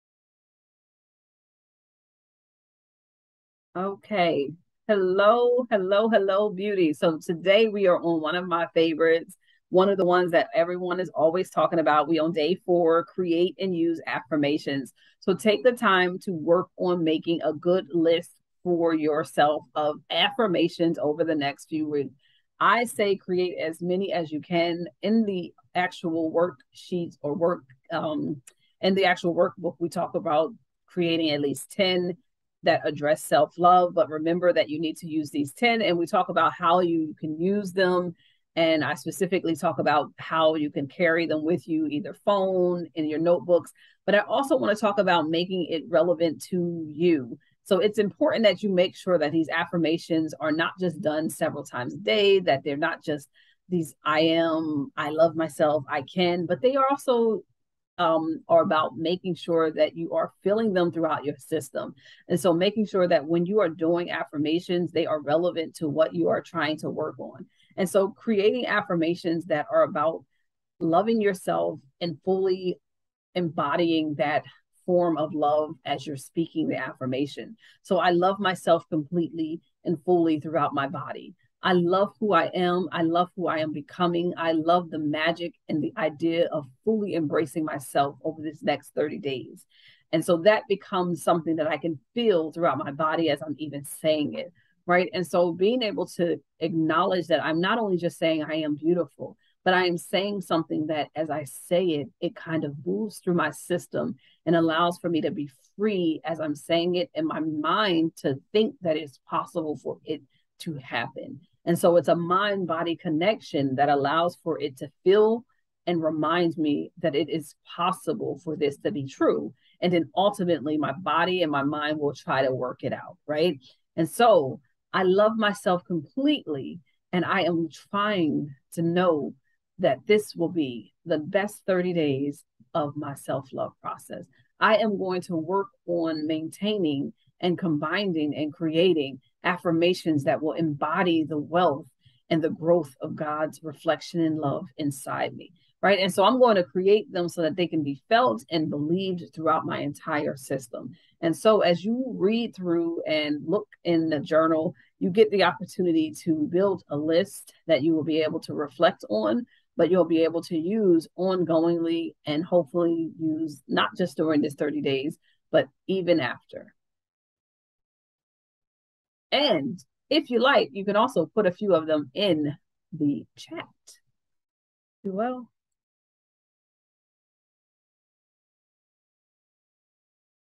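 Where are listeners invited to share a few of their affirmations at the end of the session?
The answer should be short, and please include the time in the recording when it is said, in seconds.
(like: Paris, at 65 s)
In the chat, at 172 s.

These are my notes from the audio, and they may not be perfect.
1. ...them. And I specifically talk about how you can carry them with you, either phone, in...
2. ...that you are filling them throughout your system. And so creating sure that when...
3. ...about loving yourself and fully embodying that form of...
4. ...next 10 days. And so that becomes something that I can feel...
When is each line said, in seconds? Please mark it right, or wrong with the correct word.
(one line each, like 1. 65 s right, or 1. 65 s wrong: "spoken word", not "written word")
1. 37 s right
2. 59 s wrong: "making", not "creating"
3. 69 s right
4. 88 s wrong: "30", not "10".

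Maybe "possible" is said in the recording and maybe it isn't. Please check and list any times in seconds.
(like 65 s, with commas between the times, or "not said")
109 s, 117 s.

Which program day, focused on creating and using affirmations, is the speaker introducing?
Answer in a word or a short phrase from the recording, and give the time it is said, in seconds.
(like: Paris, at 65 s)
Day 4, at 12 s.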